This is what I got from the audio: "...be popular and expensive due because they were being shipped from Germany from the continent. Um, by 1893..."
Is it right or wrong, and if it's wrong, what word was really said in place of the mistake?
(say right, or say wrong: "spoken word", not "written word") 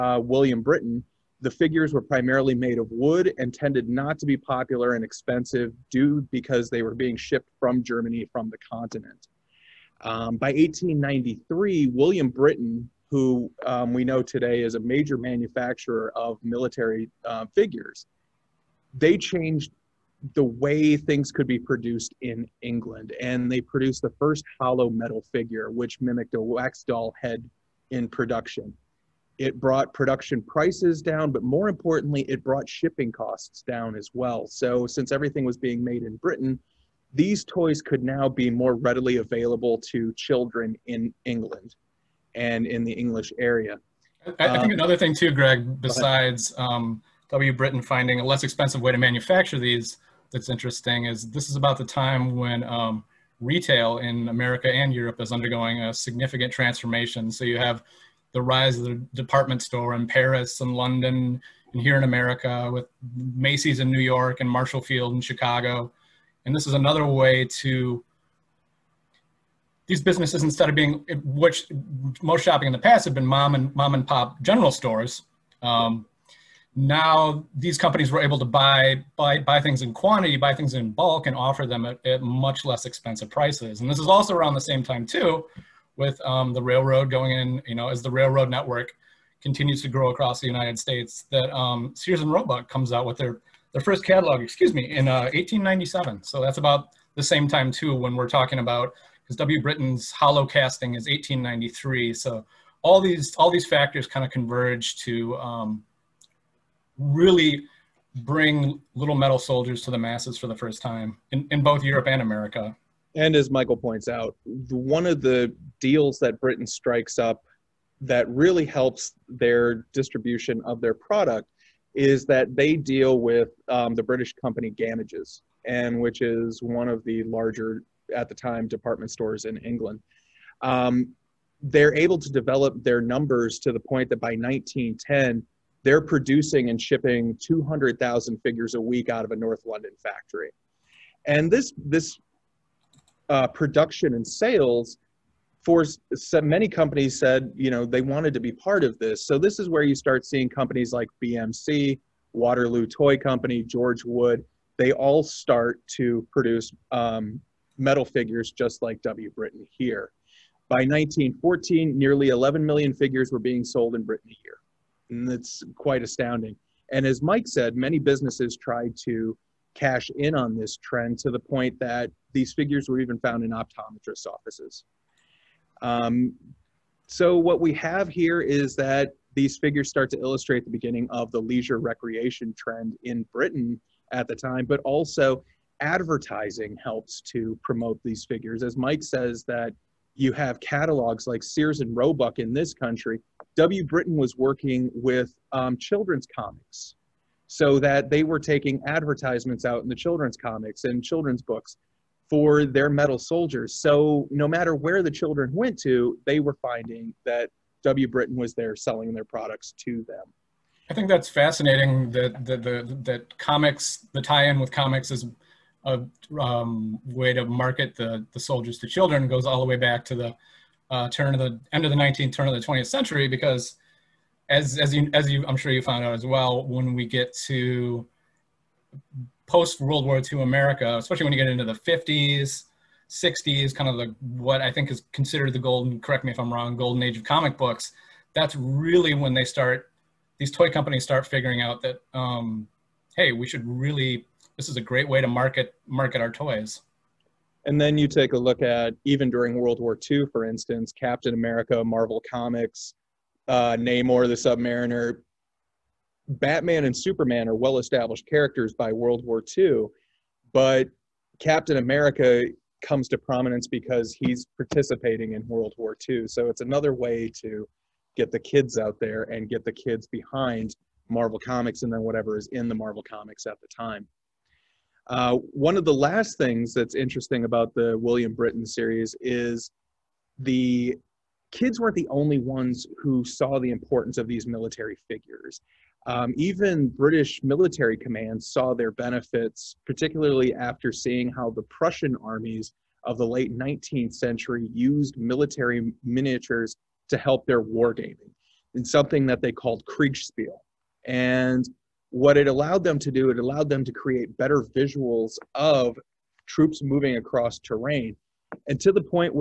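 right.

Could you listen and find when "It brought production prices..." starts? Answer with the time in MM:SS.
00:29.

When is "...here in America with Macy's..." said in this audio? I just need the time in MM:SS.
01:01.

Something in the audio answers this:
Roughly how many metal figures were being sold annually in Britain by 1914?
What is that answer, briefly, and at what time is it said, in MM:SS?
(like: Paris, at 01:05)
11 million, at 02:42.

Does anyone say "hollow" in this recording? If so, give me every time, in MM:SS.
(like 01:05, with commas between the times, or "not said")
00:24, 01:40.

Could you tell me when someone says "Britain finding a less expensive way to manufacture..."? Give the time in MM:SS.
00:47.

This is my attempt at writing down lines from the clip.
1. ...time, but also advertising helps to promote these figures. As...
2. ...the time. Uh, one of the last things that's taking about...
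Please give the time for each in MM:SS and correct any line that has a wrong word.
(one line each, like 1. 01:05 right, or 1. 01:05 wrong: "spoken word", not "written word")
1. 03:04 right
2. 04:33 wrong: "interesting", not "taking".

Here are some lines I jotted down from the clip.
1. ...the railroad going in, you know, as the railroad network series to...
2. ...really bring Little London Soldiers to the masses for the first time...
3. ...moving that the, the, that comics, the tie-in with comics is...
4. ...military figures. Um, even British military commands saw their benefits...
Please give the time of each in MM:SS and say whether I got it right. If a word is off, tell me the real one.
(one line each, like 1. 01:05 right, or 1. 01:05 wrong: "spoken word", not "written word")
1. 01:26 wrong: "continues", not "series"
2. 01:46 wrong: "Metal", not "London"
3. 03:31 wrong: "fascinating", not "moving"
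4. 04:44 right.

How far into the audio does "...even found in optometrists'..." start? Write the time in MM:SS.
02:53.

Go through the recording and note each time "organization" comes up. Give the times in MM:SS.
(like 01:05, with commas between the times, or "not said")
not said.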